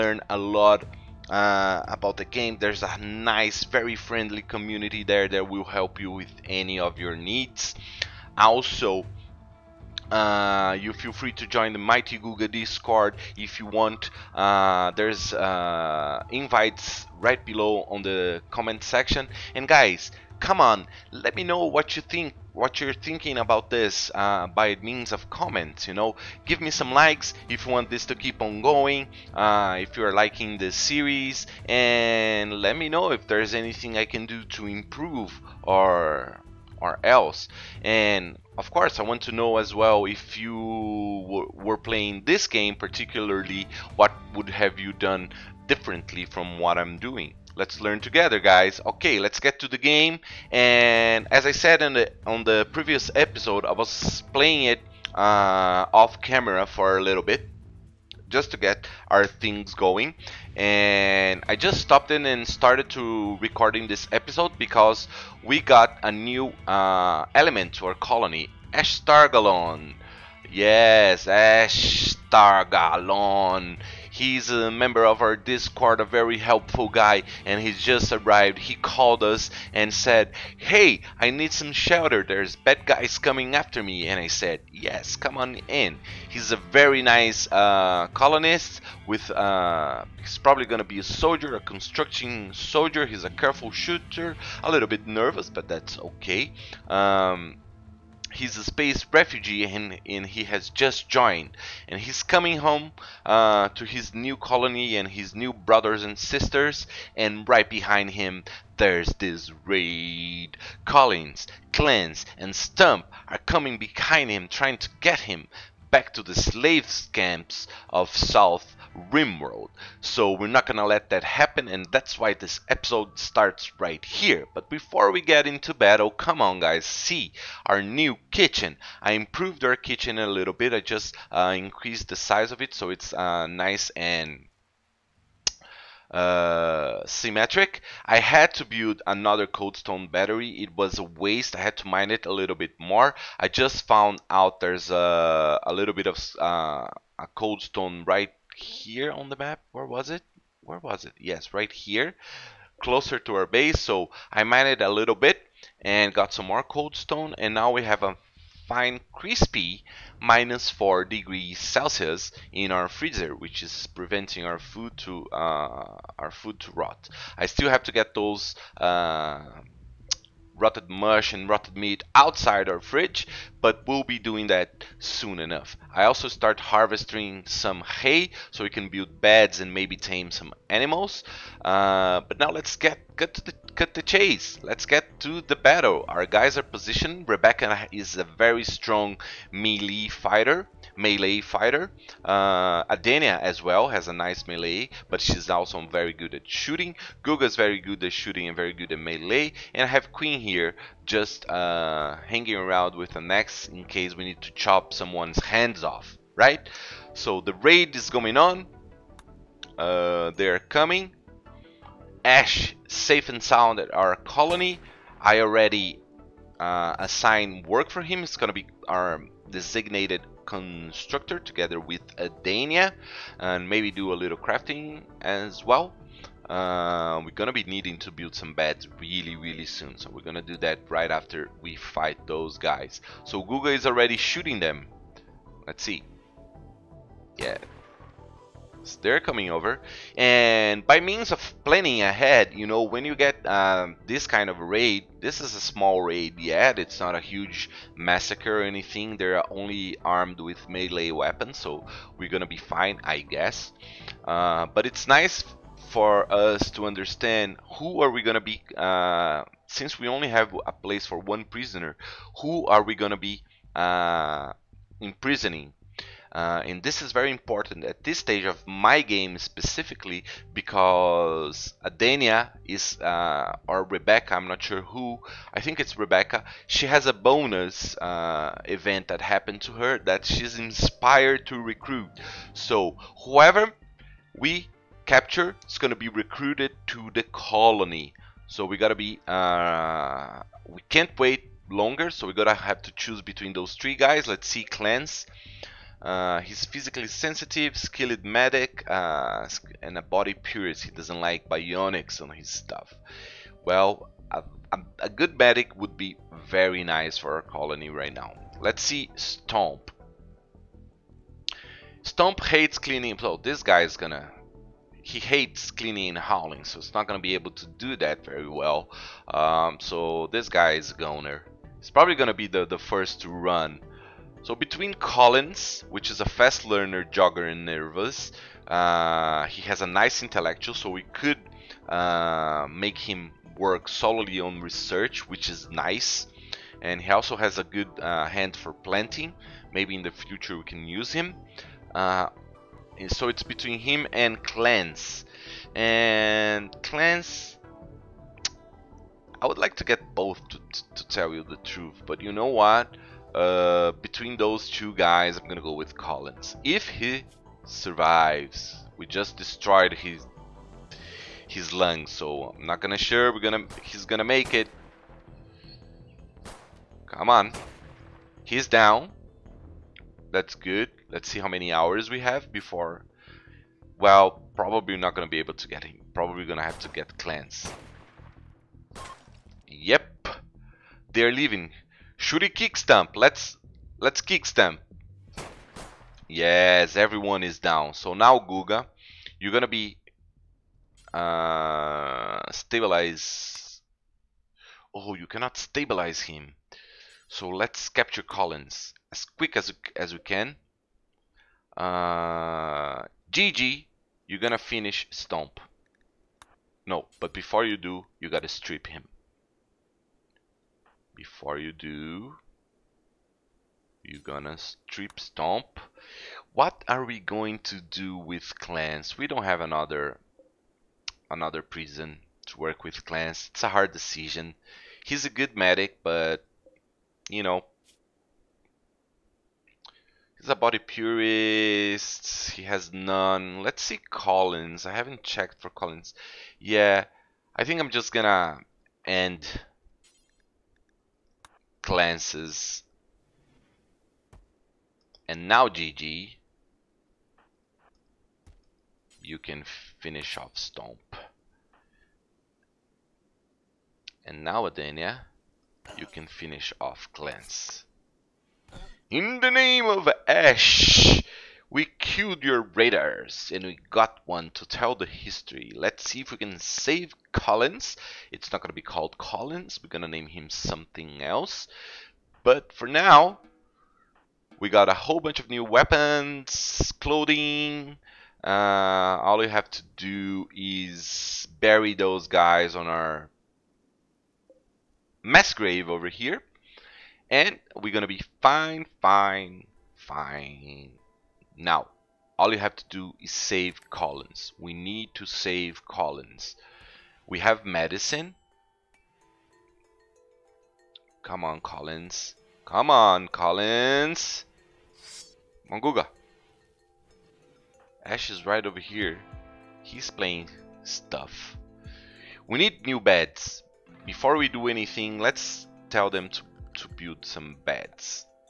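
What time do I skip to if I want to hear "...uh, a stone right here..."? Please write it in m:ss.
2:26.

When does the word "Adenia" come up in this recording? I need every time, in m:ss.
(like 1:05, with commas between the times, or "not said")
3:12, 4:31, 7:34.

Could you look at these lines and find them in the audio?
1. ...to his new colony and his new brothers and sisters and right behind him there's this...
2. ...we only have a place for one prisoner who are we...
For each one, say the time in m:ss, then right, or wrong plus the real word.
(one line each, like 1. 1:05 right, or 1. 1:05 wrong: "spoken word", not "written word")
1. 1:43 right
2. 4:19 right.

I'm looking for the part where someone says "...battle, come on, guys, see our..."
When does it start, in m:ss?
2:05.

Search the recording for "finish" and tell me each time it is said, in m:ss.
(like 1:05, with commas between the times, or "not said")
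6:44, 7:29, 7:36.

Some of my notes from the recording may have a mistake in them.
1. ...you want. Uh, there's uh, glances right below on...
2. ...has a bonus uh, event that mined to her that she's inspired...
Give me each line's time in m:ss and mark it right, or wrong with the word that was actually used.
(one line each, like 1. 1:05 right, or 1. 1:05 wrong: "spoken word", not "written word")
1. 0:13 wrong: "invites", not "glances"
2. 4:36 wrong: "happened", not "mined".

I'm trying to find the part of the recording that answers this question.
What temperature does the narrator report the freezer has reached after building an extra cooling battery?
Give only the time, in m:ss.
2:40.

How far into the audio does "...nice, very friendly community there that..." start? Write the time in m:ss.
0:02.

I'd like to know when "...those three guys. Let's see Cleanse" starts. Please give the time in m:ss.
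4:53.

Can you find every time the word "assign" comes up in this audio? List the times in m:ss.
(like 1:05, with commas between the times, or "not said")
3:36.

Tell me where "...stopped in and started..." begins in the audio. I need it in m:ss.
1:01.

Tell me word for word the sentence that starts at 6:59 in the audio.
We don't have another another prison to work with clans.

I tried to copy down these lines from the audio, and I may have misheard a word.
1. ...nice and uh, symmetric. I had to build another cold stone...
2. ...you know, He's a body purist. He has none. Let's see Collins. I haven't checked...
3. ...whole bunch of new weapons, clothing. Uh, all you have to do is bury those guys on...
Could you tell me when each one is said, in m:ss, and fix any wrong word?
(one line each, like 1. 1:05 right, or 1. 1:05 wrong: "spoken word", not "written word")
1. 2:13 right
2. 7:07 right
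3. 7:54 right.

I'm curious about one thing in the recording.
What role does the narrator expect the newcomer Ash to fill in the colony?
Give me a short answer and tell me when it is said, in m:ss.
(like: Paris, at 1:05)
Construction soldier, at 1:31.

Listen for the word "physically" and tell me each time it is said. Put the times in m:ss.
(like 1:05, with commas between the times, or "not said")
4:56.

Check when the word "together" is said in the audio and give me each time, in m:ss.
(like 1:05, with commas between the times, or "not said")
0:48, 3:41.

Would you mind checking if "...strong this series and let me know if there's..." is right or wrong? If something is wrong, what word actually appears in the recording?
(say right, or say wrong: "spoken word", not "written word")
wrong: "liking", not "strong".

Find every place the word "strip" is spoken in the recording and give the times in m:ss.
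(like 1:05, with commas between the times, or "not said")
6:48, 6:54.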